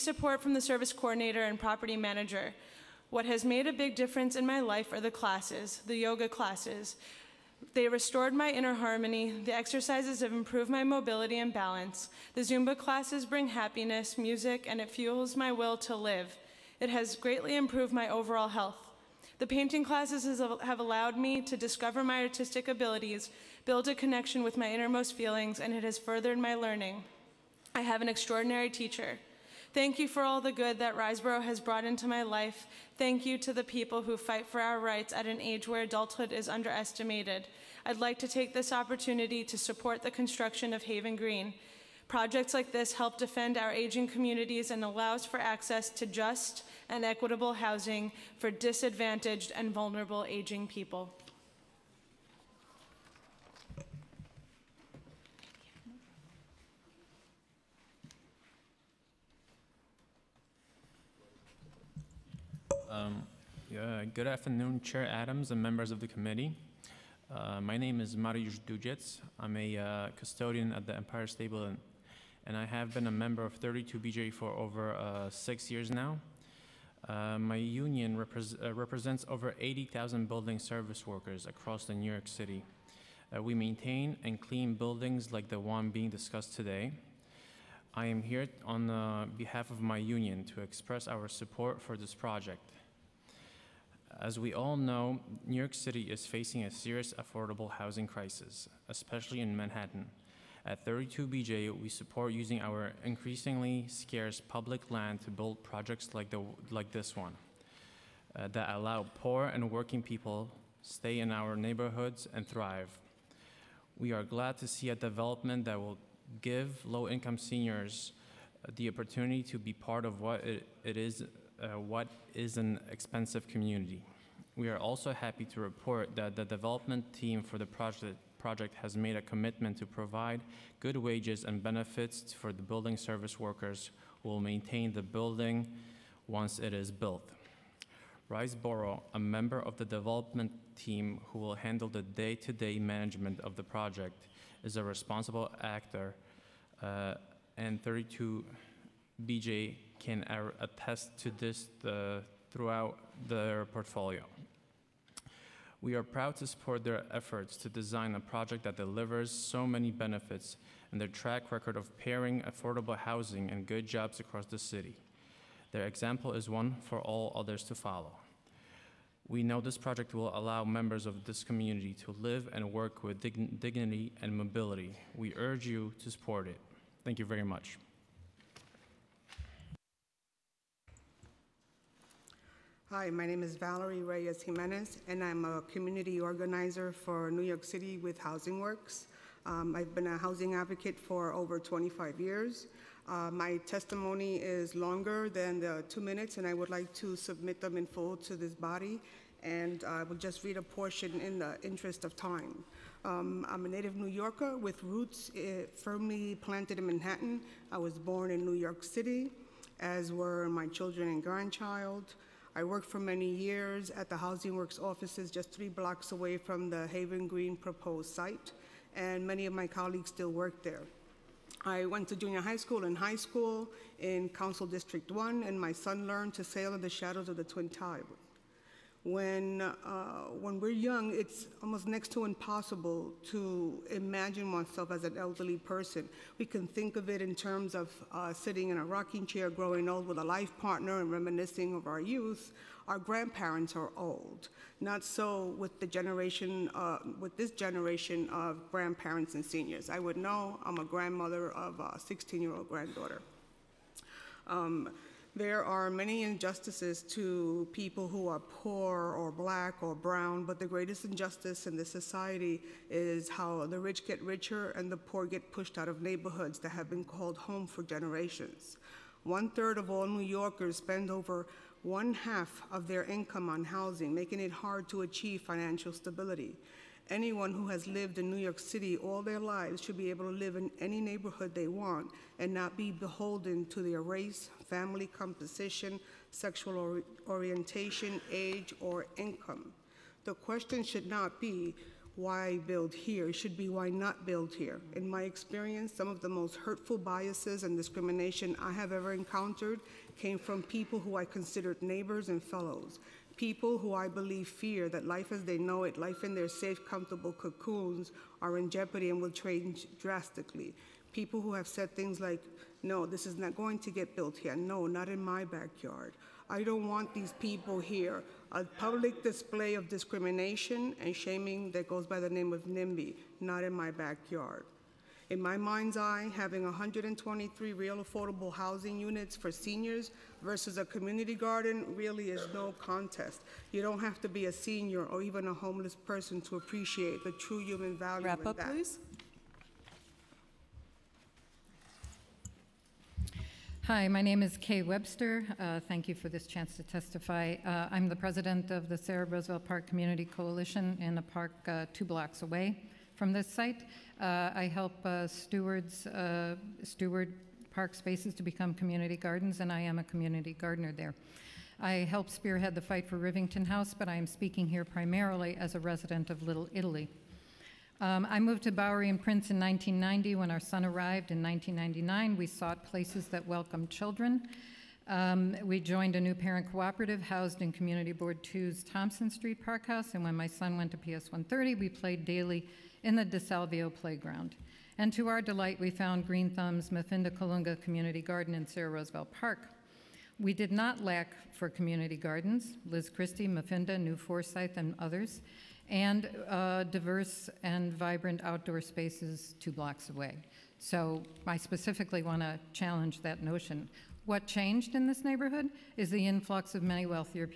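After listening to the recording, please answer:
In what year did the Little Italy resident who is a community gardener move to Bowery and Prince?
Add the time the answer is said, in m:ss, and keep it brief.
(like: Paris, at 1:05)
1990, at 6:09.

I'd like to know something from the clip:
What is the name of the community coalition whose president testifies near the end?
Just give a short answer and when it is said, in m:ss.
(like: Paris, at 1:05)
Sara Roosevelt Park Community Coalition, at 5:48.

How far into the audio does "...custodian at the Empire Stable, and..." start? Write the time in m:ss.
1:10.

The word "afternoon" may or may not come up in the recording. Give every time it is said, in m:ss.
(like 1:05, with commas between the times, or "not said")
1:04.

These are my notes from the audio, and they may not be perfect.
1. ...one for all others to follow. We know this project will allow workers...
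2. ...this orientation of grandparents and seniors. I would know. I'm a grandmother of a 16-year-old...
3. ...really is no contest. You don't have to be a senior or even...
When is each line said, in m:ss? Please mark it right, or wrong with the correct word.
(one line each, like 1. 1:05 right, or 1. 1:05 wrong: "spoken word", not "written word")
1. 2:46 wrong: "members", not "workers"
2. 4:07 wrong: "generation", not "orientation"
3. 5:31 right.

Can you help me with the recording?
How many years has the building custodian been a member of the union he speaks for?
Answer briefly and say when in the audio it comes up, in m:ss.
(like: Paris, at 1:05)
6, at 1:15.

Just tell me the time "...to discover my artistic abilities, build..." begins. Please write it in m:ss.
0:21.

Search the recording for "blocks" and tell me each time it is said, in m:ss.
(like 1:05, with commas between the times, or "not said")
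3:35, 5:52, 6:39.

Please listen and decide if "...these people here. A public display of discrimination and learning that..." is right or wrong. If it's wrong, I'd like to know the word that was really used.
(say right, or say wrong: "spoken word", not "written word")
wrong: "shaming", not "learning".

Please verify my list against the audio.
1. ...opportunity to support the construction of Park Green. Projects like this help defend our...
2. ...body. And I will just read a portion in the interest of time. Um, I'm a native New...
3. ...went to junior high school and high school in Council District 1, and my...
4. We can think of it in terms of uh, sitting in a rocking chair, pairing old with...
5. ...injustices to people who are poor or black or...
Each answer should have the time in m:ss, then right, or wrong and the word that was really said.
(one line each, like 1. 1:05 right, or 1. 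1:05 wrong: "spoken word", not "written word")
1. 0:38 wrong: "Haven", not "Park"
2. 3:18 right
3. 3:41 right
4. 3:56 wrong: "growing", not "pairing"
5. 4:16 right.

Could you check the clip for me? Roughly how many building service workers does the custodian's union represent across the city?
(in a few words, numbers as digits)
80,000.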